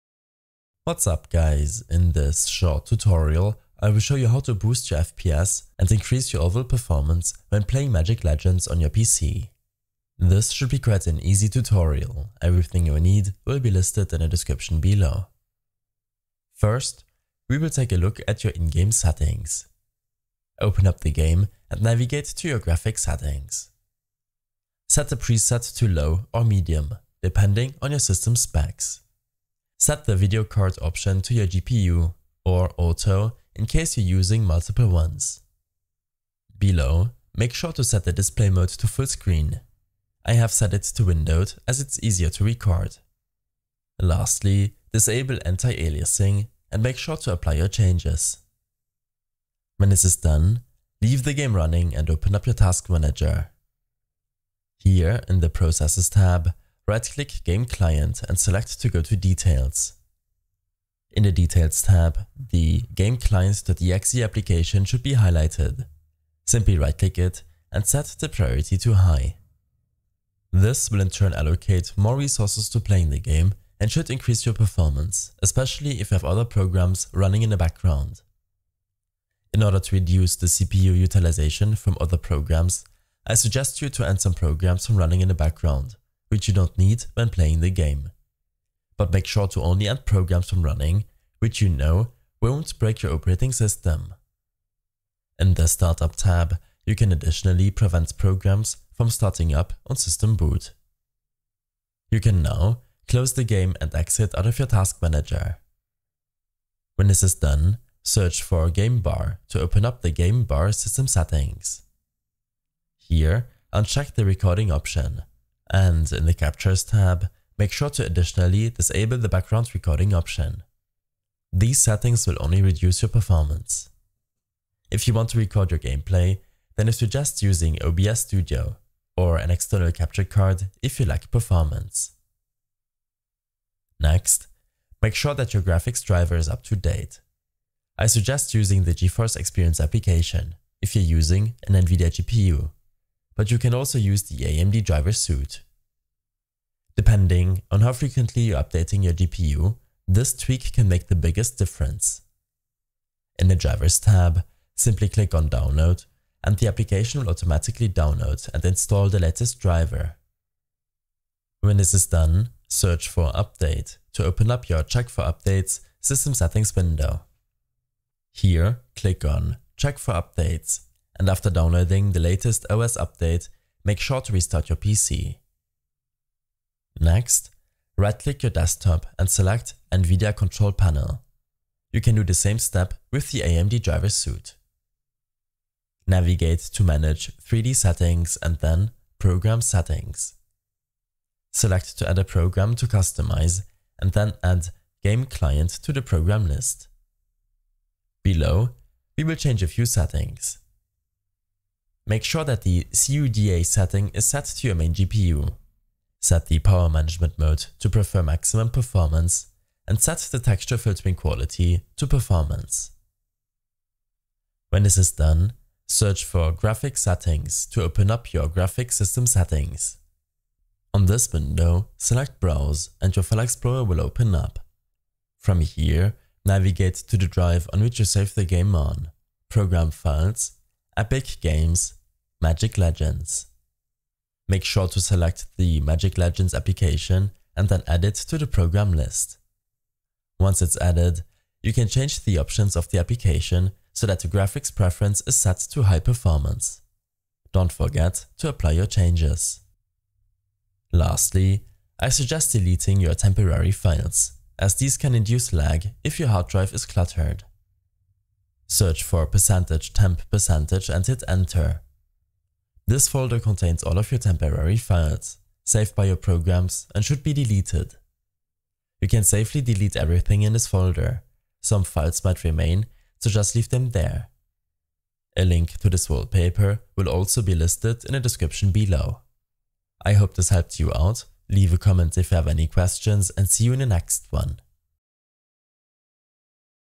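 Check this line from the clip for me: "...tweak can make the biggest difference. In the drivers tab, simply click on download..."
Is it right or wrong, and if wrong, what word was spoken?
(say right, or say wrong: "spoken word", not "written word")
right.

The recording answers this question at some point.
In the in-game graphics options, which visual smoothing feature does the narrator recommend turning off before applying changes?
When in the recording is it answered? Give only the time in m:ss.
0:45.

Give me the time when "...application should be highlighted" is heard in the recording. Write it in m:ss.
1:03.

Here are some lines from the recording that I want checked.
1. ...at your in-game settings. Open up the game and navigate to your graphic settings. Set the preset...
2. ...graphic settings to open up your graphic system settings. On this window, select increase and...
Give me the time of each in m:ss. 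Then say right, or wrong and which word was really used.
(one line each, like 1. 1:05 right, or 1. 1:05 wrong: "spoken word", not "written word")
1. 0:18 right
2. 3:36 wrong: "browse", not "increase".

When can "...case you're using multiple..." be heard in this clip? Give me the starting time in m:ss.
0:33.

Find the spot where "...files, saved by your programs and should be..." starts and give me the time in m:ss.
4:24.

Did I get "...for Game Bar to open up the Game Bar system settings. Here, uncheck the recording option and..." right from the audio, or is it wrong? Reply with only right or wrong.
right.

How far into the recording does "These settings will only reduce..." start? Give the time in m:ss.
2:01.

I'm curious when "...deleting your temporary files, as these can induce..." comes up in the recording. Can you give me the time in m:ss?
4:12.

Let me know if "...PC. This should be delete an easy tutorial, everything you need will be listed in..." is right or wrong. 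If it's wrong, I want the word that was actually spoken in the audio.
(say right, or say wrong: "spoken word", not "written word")
wrong: "quite", not "delete".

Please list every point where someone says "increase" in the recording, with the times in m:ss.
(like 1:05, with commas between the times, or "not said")
0:05, 1:14.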